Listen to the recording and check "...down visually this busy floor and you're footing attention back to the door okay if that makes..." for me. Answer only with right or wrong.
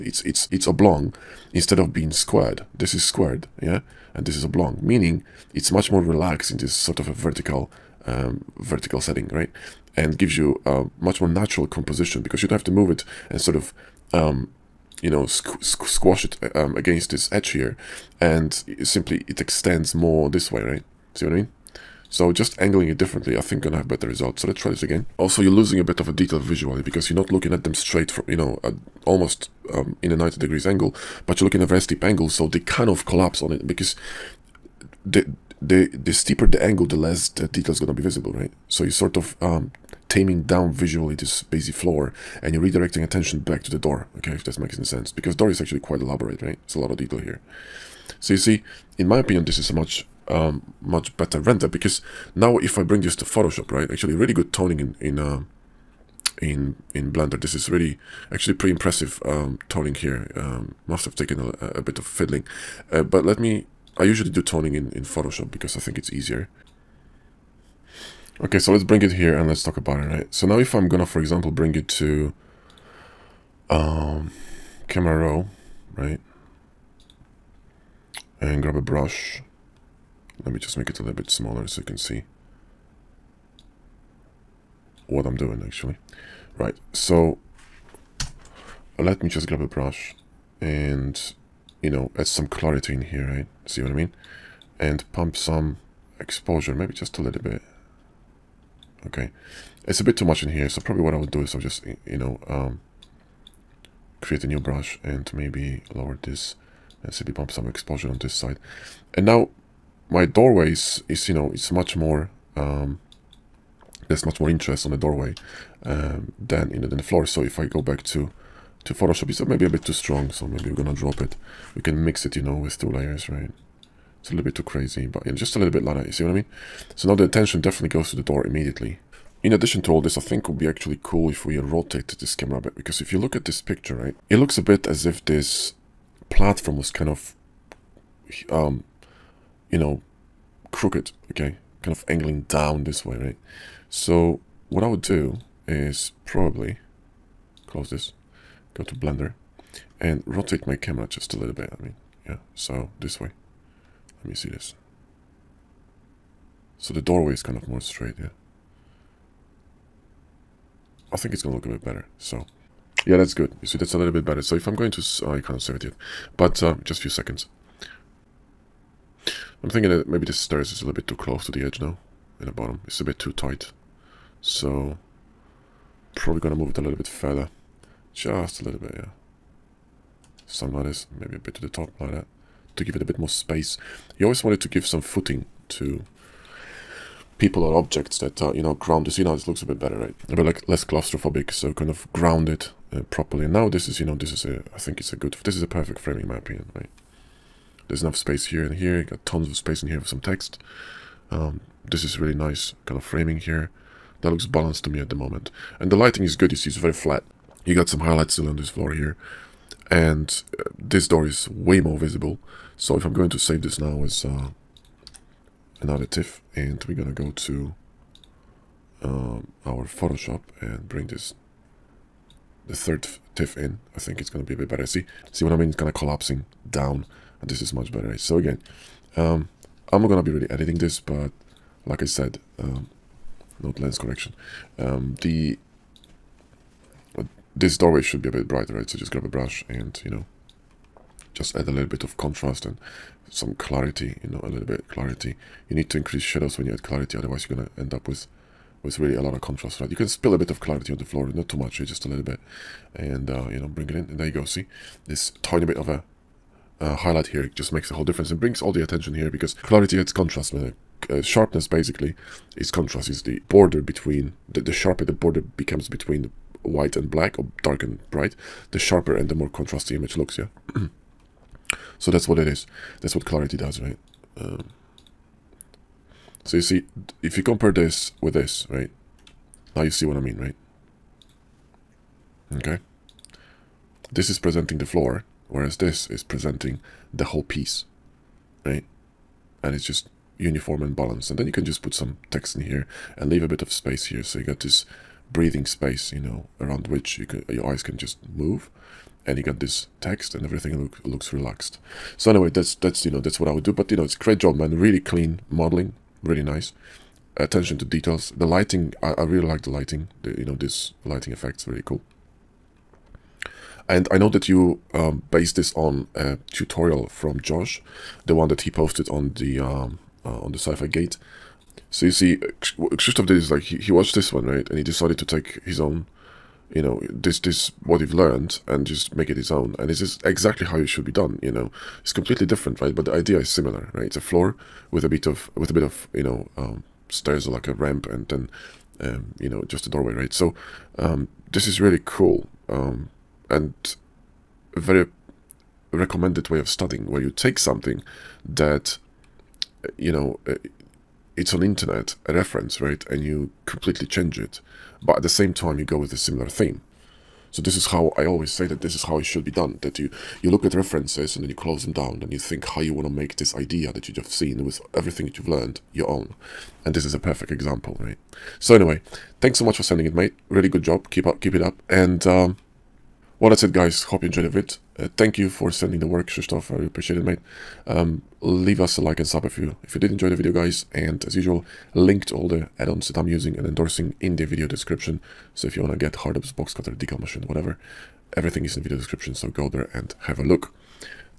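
wrong.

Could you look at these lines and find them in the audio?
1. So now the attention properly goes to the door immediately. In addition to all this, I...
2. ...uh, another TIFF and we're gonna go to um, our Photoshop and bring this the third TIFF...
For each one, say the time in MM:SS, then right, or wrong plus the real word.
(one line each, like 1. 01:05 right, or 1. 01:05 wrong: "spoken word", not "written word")
1. 02:06 wrong: "definitely", not "properly"
2. 03:34 right.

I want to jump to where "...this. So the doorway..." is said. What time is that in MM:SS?
02:34.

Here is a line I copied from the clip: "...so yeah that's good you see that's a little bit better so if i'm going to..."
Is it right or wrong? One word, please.
right.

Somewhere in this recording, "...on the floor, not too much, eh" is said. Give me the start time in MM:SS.
04:10.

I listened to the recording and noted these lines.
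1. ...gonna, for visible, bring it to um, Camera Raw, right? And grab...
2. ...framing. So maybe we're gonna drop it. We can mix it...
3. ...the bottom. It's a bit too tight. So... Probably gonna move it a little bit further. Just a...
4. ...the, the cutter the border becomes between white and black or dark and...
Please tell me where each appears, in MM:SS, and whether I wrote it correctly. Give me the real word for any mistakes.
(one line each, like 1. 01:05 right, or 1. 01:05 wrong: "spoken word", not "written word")
1. 01:10 wrong: "example", not "visible"
2. 01:59 wrong: "strong", not "framing"
3. 02:52 right
4. 04:24 wrong: "sharper", not "cutter".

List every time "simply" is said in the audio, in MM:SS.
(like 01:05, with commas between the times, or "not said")
00:18, 01:47.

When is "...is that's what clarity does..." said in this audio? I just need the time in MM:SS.
04:32.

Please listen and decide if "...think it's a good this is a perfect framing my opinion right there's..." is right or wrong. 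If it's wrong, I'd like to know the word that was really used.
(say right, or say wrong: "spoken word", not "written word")
right.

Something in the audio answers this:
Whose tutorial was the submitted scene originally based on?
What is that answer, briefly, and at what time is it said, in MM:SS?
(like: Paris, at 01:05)
Josh, at 05:17.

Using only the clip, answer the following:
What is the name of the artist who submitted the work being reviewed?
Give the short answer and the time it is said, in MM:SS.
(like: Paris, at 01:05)
Krzysztof, at 05:22.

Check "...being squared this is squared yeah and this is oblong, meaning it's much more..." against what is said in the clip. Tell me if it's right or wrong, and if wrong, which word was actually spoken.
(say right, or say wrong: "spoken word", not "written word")
right.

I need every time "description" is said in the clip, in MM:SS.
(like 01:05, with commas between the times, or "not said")
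06:24, 06:28.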